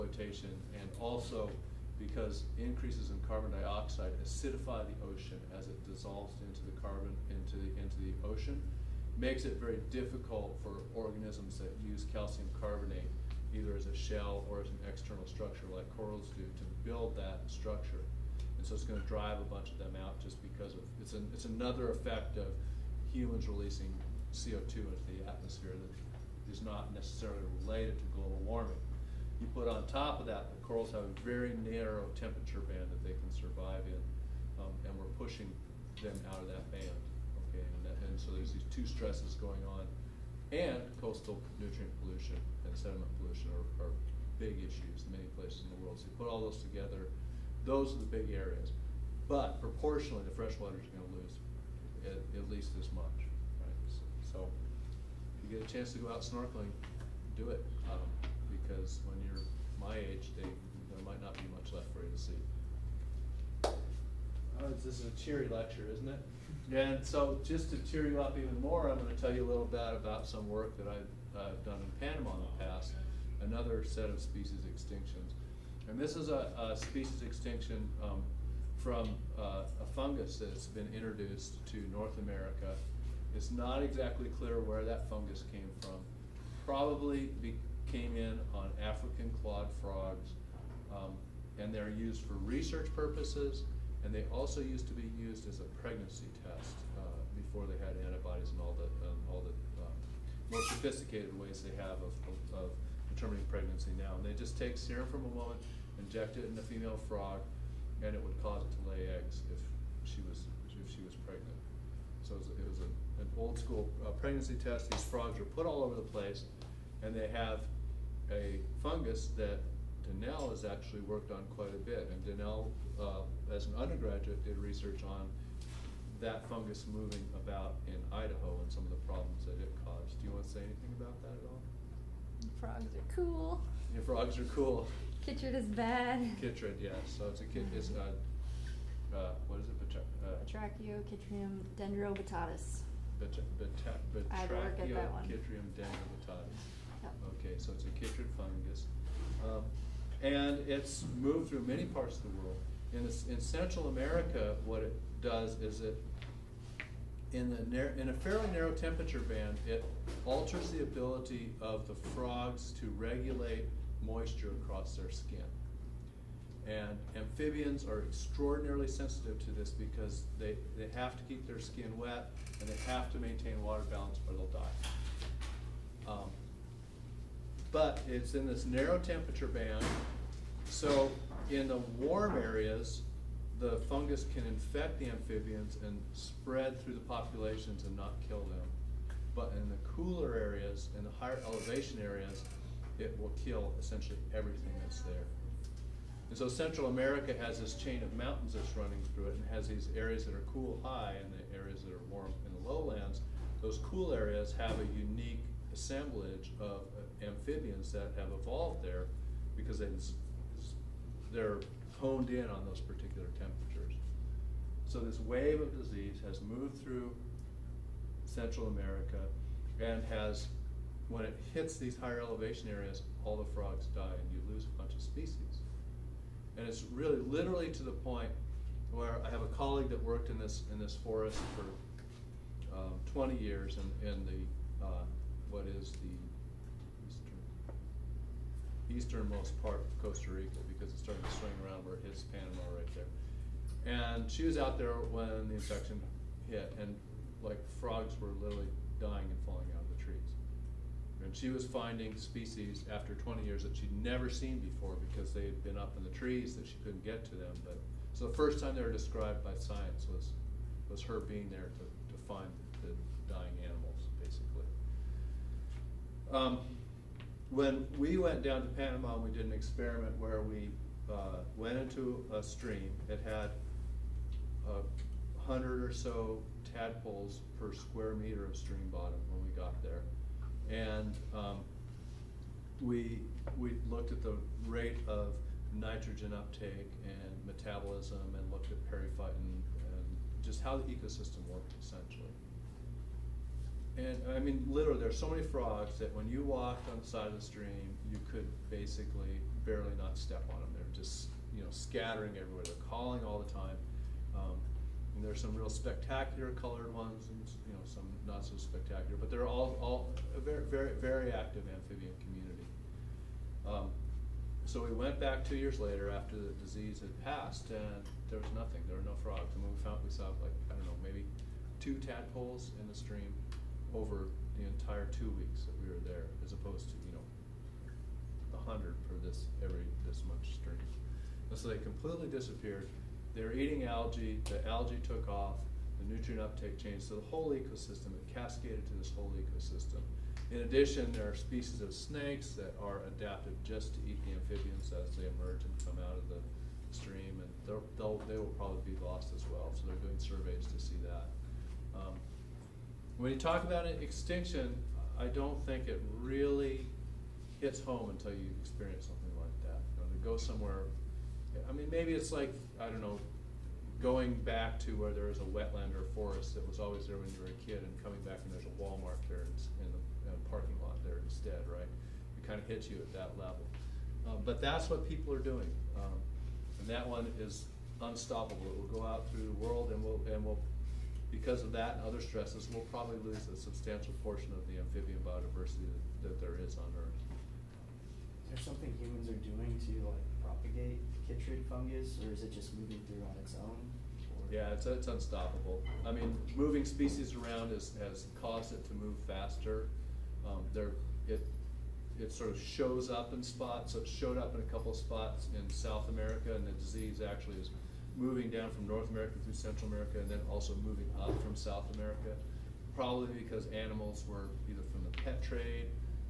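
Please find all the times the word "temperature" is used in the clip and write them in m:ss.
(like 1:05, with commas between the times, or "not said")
0:32, 2:38, 2:58, 3:33.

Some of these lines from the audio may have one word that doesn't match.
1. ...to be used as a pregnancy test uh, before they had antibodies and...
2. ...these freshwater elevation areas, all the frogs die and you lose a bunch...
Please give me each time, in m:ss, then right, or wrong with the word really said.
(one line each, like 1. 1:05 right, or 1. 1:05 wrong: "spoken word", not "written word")
1. 1:34 right
2. 3:41 wrong: "higher", not "freshwater".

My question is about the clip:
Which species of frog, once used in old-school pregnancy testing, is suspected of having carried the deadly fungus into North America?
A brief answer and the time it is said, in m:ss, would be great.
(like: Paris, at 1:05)
African clawed frogs, at 1:28.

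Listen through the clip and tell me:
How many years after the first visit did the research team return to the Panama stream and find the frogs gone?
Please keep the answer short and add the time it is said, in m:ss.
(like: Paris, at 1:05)
2 years, at 5:15.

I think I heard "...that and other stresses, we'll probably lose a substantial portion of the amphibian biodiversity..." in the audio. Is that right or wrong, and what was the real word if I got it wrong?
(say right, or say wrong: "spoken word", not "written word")
right.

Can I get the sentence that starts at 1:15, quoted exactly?
And this is a, a species extinction um, from uh, a fungus that's been introduced to North America.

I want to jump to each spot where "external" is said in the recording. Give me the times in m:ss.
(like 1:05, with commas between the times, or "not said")
0:14.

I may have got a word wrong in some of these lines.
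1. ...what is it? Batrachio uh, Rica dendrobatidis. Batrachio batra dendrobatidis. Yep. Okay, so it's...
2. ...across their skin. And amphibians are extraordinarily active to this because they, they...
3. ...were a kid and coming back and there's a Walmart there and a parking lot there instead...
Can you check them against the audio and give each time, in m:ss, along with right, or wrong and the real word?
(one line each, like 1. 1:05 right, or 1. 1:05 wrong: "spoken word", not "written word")
1. 2:19 wrong: "Batrachochytrium", not "Rica"
2. 2:44 wrong: "sensitive", not "active"
3. 6:07 right.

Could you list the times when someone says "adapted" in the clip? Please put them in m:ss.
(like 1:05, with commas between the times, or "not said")
5:43.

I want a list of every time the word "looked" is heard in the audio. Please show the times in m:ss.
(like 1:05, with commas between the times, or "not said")
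4:43, 4:48.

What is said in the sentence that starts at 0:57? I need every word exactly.
Um, because when you're my age, they, there might not be much left for you to see.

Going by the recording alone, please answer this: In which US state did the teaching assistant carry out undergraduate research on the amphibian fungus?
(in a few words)
Idaho.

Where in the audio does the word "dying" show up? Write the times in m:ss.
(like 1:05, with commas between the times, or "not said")
4:08, 4:23.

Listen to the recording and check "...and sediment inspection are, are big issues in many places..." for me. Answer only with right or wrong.
wrong.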